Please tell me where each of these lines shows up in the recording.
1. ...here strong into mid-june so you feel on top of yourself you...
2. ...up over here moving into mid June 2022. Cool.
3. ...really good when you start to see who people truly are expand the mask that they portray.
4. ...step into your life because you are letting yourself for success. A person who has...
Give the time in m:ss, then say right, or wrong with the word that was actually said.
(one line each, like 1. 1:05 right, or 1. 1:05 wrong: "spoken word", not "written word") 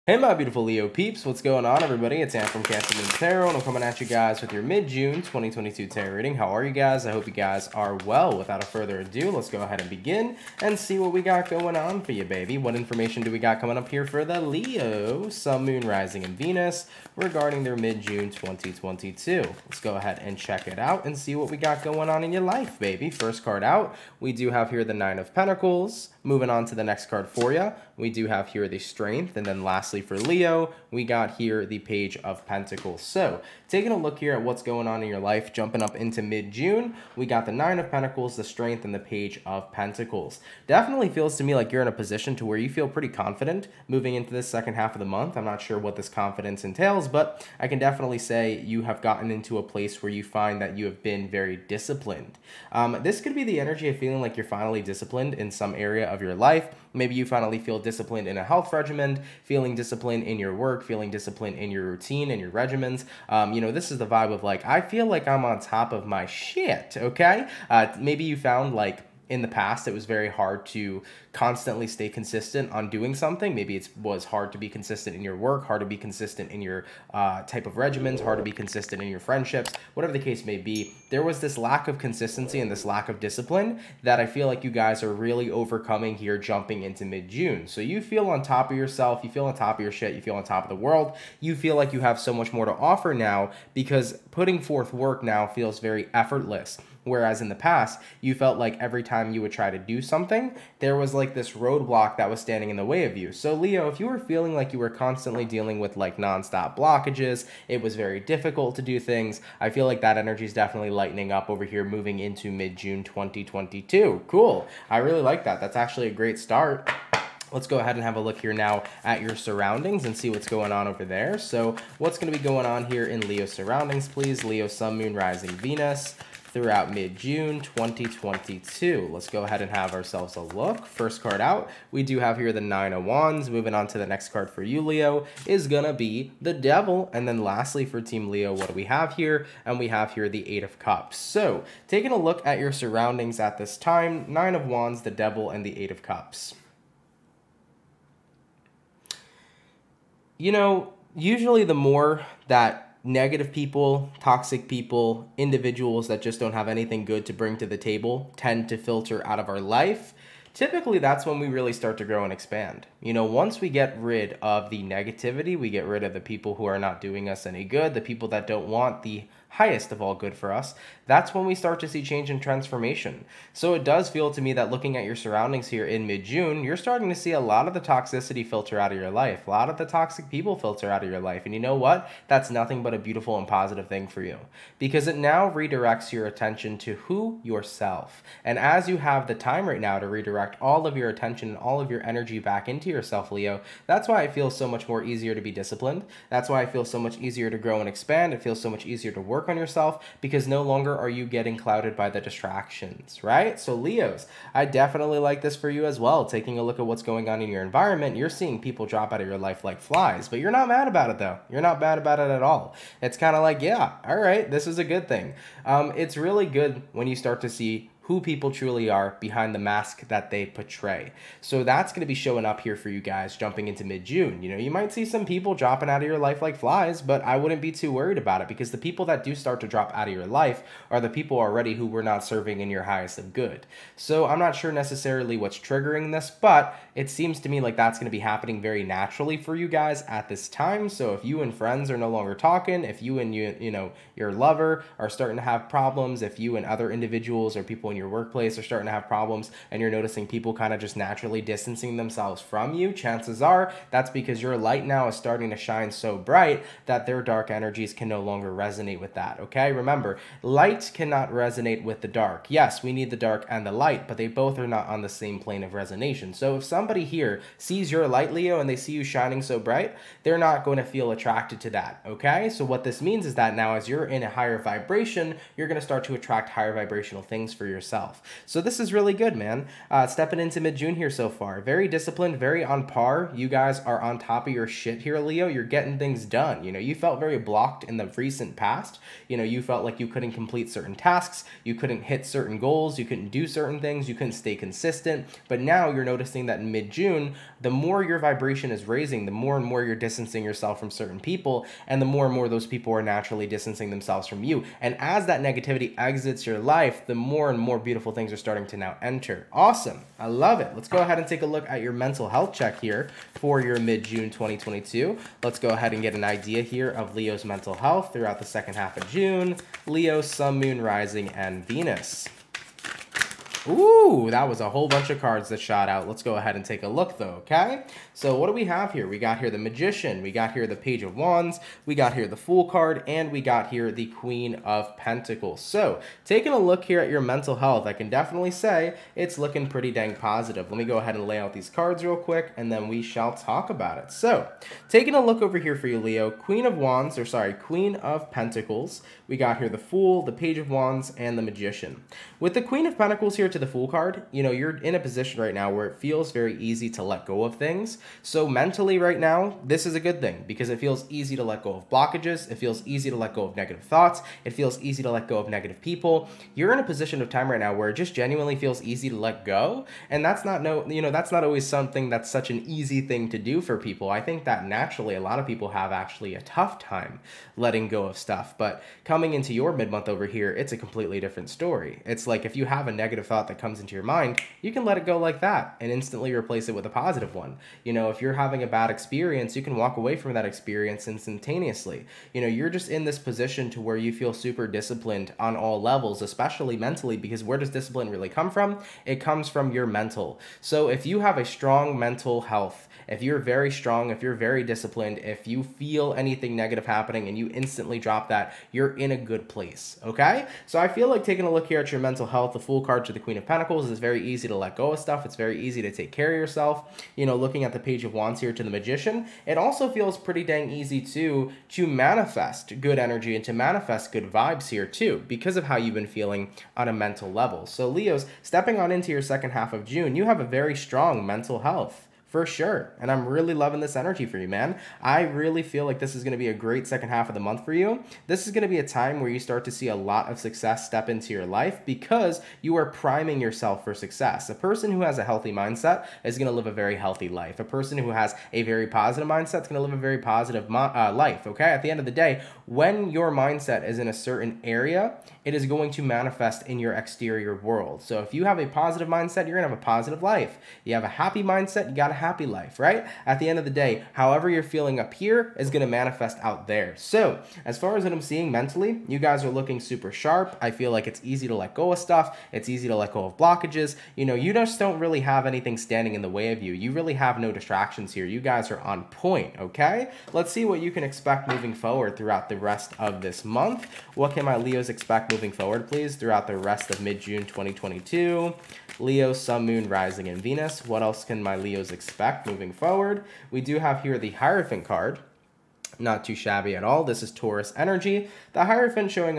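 1. 1:26 wrong: "jumping", not "strong"
2. 1:51 right
3. 3:36 wrong: "behind", not "expand"
4. 7:20 wrong: "priming", not "letting".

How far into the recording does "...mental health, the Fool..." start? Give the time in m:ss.
6:52.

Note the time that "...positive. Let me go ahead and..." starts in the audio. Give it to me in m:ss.
5:40.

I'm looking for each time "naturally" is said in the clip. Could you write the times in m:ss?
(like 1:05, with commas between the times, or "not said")
3:58, 4:10, 5:03, 6:14.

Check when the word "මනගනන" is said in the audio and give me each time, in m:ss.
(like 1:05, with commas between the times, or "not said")
not said.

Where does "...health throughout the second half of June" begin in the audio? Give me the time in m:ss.
5:17.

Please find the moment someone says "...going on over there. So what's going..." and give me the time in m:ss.
2:00.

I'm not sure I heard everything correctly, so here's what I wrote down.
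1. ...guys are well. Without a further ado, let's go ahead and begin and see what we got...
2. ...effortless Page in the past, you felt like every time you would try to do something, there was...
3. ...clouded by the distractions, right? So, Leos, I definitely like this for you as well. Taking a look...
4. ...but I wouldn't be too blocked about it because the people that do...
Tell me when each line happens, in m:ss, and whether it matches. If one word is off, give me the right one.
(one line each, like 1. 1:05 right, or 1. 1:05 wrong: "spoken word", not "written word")
1. 0:07 right
2. 1:36 wrong: "Whereas", not "Page"
3. 3:21 right
4. 3:47 wrong: "worried", not "blocked".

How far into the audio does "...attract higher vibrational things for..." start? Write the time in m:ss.
4:36.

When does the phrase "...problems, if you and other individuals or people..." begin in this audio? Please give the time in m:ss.
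4:05.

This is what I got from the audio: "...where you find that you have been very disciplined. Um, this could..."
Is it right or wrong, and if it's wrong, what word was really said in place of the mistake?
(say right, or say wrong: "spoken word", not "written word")
right.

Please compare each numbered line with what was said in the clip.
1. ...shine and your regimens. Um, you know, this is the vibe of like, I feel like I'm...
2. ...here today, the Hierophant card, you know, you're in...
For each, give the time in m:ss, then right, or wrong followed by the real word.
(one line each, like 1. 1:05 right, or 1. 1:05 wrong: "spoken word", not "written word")
1. 1:01 wrong: "routine", not "shine"
2. 5:53 wrong: "Fool", not "Hierophant".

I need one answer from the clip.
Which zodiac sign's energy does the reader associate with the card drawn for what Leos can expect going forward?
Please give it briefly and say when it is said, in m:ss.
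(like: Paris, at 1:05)
Taurus, at 8:17.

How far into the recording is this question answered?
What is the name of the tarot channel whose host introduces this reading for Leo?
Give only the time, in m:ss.
0:02.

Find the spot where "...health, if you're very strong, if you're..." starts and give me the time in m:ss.
6:42.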